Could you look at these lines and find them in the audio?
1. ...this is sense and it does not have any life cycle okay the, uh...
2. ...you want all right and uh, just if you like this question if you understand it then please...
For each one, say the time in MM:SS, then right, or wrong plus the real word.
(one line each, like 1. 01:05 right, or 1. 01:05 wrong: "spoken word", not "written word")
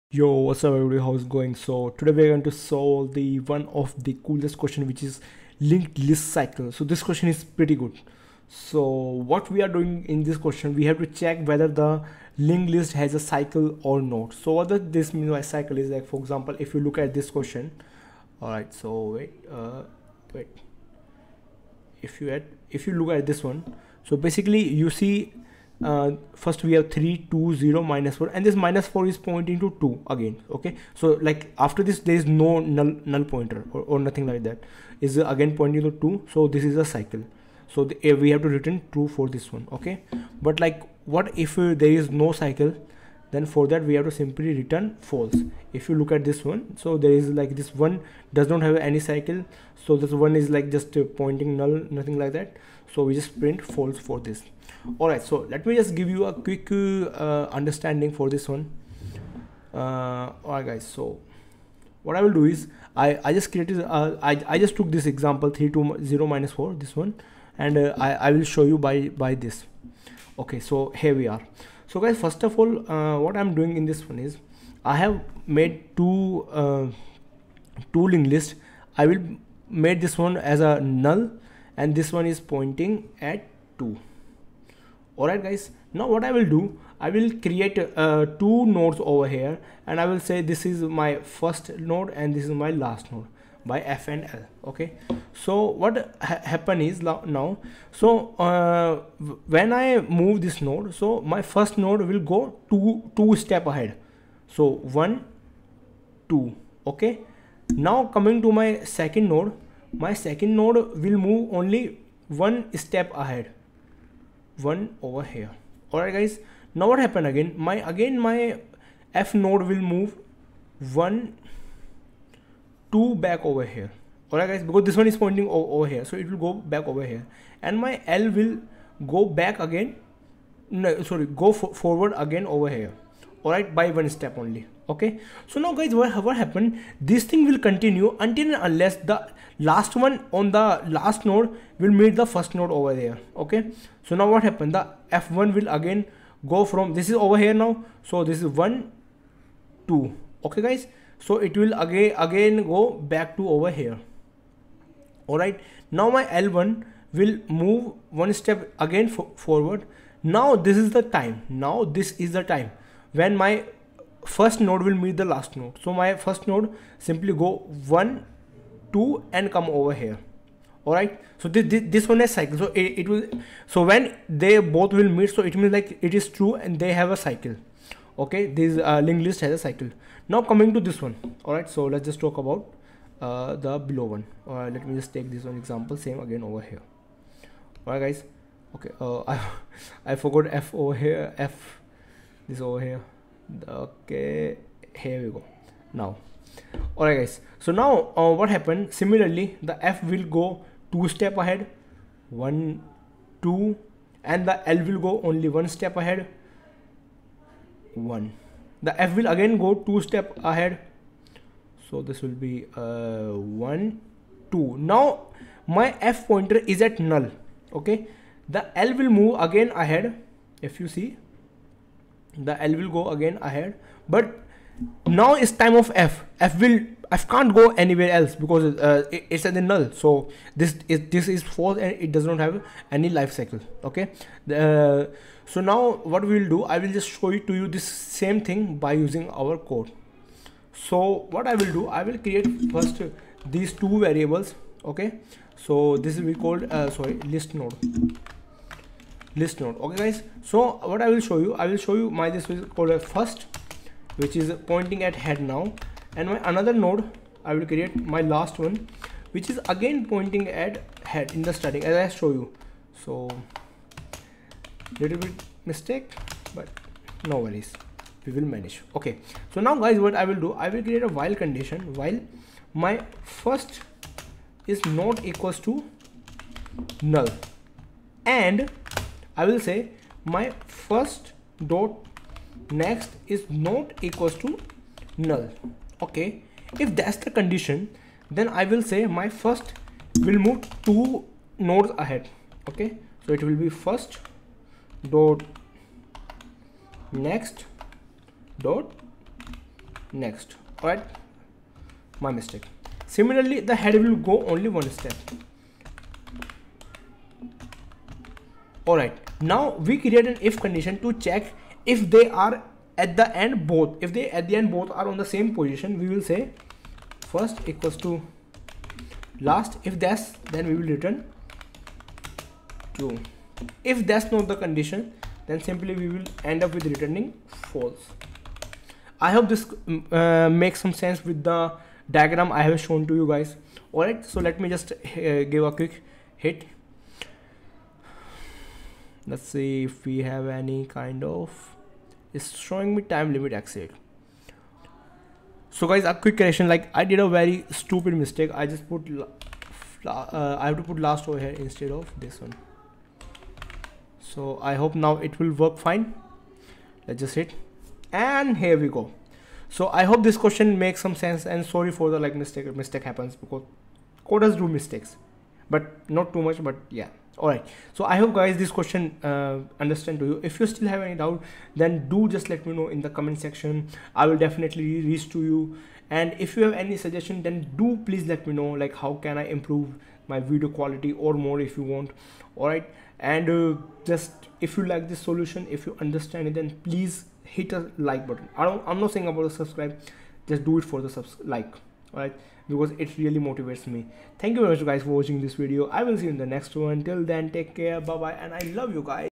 1. 03:51 wrong: "false", not "sense"
2. 06:21 wrong: "solution", not "question".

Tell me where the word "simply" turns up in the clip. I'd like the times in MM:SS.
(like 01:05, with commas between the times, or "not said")
00:44, 02:47, 05:25.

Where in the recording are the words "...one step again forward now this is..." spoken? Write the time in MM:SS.
02:38.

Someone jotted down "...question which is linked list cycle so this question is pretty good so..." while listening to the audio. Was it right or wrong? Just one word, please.
right.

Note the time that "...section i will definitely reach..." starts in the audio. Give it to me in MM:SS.
06:13.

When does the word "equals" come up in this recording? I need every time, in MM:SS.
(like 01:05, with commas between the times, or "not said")
04:35, 04:44, 05:17.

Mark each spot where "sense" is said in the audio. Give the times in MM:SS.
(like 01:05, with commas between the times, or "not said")
05:31, 06:01.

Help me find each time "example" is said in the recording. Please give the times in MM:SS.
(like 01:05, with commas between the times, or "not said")
00:16, 01:05, 03:05.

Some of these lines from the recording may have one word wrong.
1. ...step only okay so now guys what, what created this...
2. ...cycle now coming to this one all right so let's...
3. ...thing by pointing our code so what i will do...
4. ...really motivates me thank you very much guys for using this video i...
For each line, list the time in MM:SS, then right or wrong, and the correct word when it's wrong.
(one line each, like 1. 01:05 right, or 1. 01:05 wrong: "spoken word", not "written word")
1. 02:14 wrong: "happened", not "created"
2. 02:59 right
3. 03:58 wrong: "using", not "pointing"
4. 06:33 wrong: "watching", not "using".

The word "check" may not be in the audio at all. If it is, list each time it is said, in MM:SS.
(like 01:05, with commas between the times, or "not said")
00:11, 05:11.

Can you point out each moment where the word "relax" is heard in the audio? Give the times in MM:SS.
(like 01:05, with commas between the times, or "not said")
not said.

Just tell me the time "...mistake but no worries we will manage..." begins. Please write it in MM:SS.
04:25.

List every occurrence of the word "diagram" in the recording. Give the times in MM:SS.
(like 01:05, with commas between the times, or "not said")
05:32.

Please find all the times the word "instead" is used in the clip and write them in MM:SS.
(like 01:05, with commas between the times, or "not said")
05:51.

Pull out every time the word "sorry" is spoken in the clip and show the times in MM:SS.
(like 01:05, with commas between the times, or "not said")
02:11, 04:06, 06:01.